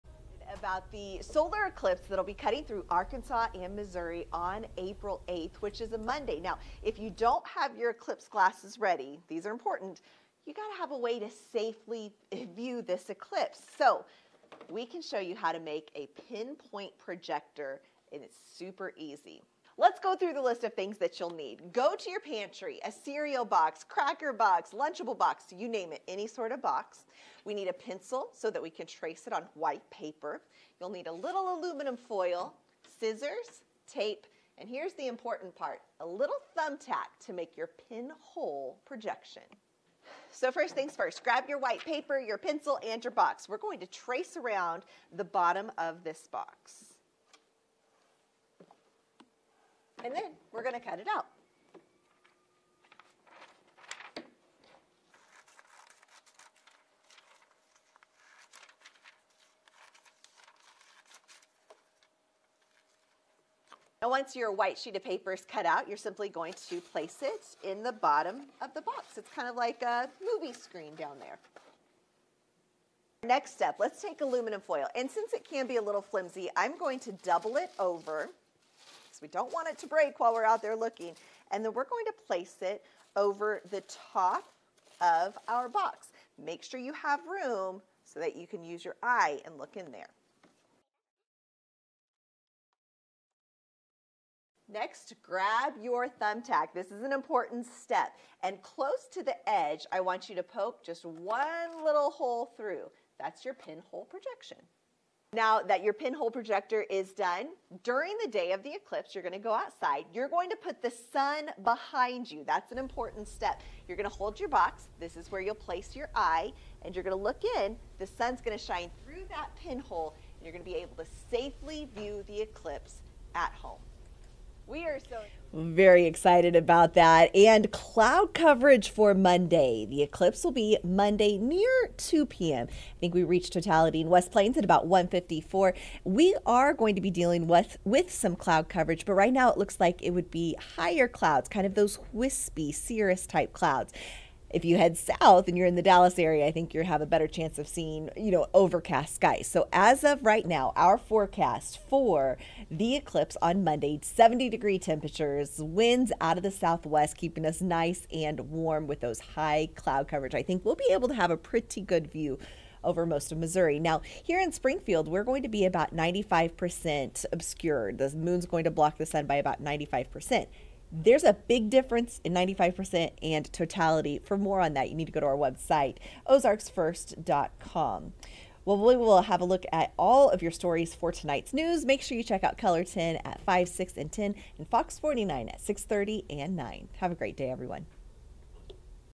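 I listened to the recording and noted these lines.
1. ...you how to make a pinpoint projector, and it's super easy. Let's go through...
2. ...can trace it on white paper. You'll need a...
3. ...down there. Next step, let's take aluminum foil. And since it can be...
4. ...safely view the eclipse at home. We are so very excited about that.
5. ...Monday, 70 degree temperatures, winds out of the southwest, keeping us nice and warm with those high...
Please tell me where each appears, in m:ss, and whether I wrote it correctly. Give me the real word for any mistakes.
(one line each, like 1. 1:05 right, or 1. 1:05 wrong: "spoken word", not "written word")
1. 0:15 right
2. 0:28 right
3. 1:10 right
4. 2:01 right
5. 2:33 right.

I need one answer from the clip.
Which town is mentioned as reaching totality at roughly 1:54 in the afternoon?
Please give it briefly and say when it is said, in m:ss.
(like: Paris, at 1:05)
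West Plains, at 2:14.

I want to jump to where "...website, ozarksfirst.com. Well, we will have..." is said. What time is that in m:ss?
2:55.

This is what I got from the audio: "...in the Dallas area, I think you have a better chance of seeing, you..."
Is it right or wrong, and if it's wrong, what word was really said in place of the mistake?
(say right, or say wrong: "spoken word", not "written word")
right.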